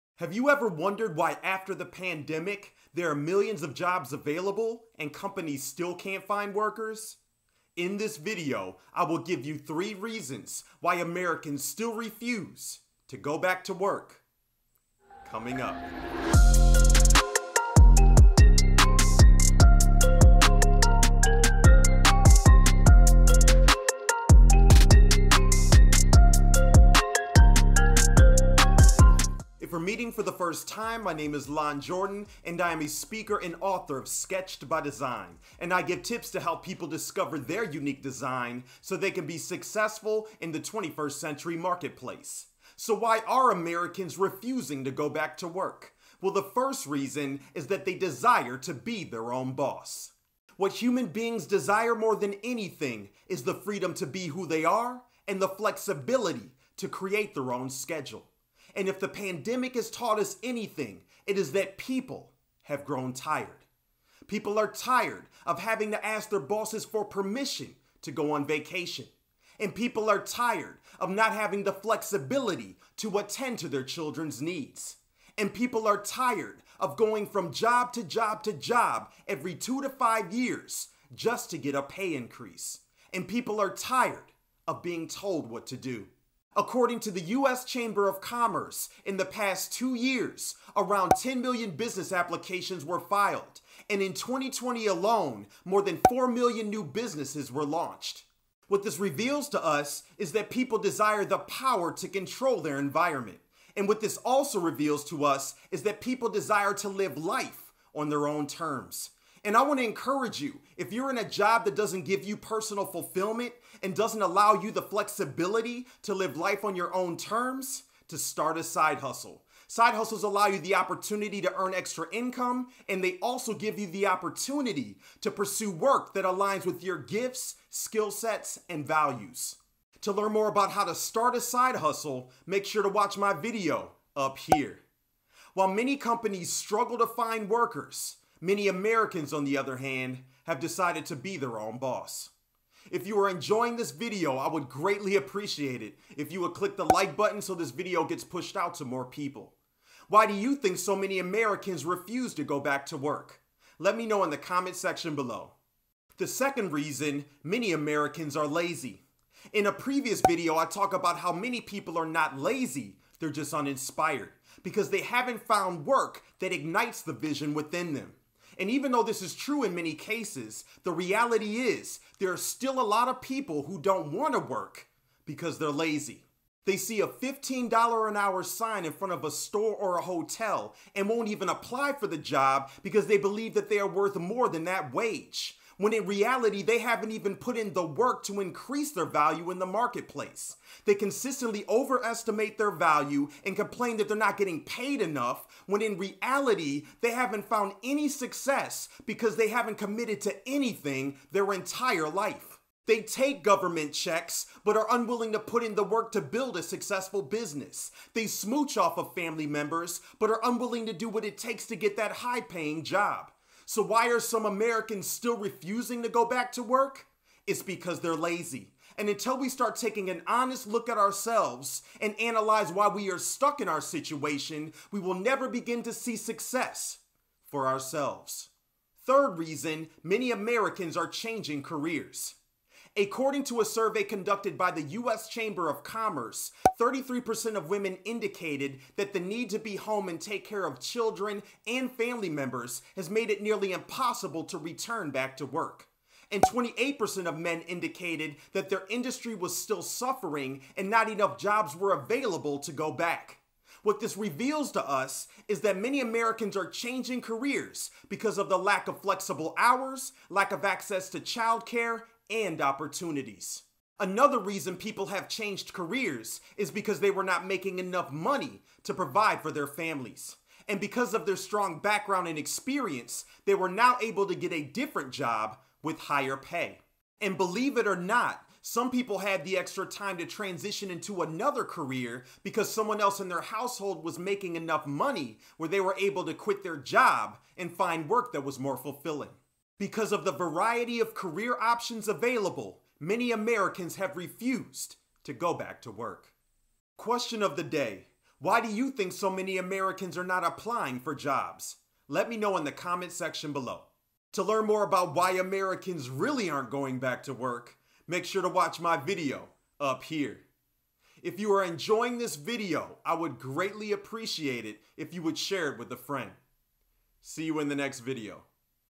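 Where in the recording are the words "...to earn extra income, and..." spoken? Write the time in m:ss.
2:01.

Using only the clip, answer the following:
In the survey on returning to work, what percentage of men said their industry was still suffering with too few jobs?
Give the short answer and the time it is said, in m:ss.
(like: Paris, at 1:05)
28%, at 4:06.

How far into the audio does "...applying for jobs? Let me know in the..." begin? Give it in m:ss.
5:00.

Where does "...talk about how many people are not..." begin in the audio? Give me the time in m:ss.
2:40.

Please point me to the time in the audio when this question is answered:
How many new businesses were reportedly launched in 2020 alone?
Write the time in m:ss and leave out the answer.
1:35.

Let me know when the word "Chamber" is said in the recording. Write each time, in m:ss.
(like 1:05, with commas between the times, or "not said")
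1:27, 3:55.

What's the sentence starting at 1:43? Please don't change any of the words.
And what this also reveals to us is that people desire to live life on their own terms.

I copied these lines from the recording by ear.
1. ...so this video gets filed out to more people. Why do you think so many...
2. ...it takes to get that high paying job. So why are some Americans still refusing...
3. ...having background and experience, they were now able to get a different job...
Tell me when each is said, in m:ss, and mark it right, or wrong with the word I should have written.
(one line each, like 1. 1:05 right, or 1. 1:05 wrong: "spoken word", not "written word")
1. 2:27 wrong: "pushed", not "filed"
2. 3:31 right
3. 4:31 wrong: "strong", not "having".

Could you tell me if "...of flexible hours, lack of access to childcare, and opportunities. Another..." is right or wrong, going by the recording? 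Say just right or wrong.
right.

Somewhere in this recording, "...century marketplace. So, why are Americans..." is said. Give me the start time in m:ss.
0:41.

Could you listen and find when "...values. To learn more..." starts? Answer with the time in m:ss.
2:08.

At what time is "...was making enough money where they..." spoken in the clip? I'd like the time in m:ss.
4:44.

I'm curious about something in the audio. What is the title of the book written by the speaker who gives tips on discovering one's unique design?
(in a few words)
Sketched by Design.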